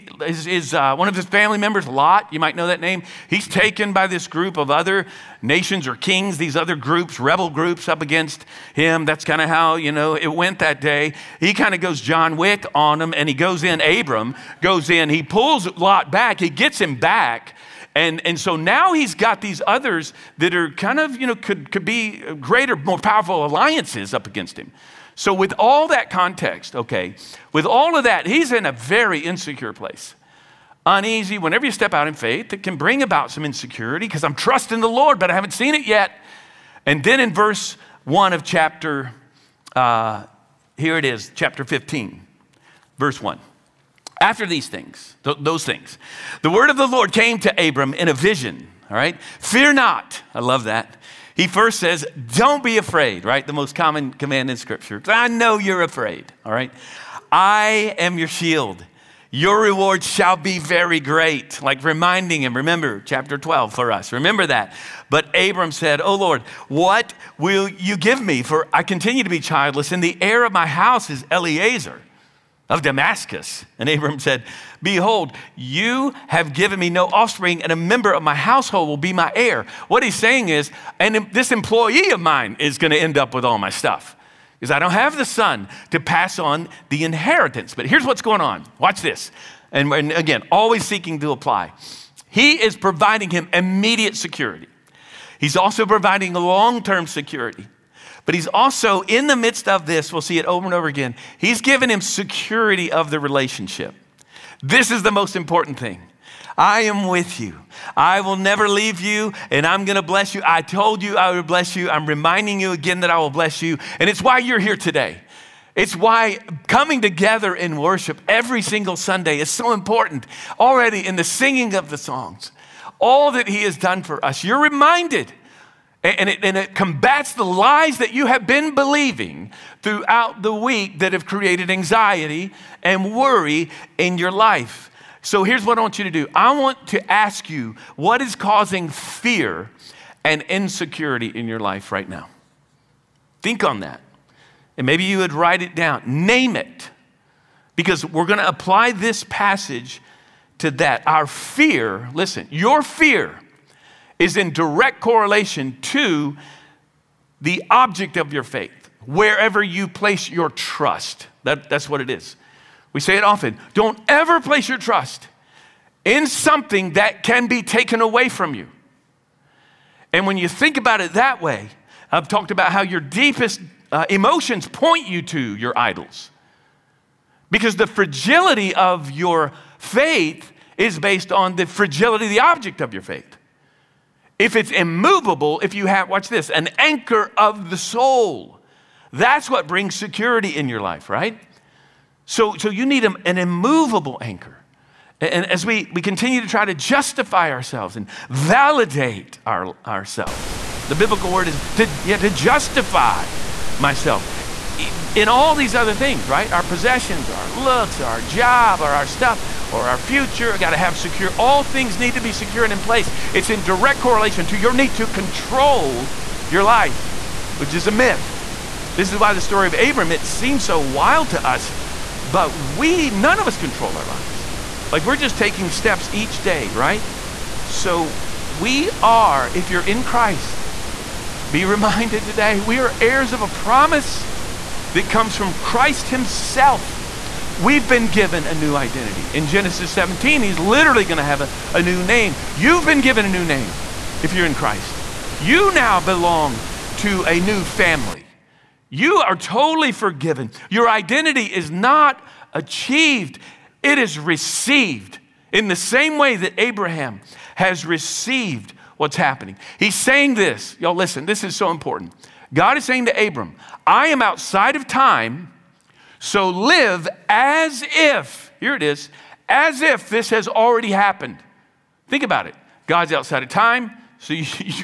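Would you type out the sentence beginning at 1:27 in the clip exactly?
But here's what's going on watch this.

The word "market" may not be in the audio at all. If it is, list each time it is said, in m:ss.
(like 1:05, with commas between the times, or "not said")
not said.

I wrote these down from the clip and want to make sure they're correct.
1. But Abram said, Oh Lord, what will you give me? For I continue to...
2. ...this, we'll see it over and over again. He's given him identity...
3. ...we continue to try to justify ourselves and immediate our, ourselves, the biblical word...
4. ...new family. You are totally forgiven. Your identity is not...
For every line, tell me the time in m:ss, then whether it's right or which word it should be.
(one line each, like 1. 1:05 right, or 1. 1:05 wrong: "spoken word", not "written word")
1. 1:05 right
2. 1:39 wrong: "security", not "identity"
3. 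3:15 wrong: "validate", not "immediate"
4. 4:07 right.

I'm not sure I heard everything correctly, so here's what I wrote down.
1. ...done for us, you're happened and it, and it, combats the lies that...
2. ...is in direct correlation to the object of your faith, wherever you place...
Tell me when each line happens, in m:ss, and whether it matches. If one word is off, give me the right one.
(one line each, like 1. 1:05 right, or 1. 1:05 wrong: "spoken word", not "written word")
1. 2:03 wrong: "reminded", not "happened"
2. 2:34 right.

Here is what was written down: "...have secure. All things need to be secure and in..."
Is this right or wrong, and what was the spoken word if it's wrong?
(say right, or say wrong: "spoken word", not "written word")
right.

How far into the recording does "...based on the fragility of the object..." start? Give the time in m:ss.
3:00.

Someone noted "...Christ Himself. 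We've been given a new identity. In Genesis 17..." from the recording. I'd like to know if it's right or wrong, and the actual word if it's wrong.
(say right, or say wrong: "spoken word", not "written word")
right.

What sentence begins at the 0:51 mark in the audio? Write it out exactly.
He first says, Don't be afraid, right?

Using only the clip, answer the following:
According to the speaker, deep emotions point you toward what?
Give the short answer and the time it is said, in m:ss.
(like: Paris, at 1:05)
Idols, at 2:55.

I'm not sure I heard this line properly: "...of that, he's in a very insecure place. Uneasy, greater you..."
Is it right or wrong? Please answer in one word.
wrong.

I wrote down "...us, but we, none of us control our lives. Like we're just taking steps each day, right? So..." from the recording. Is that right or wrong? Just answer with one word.
right.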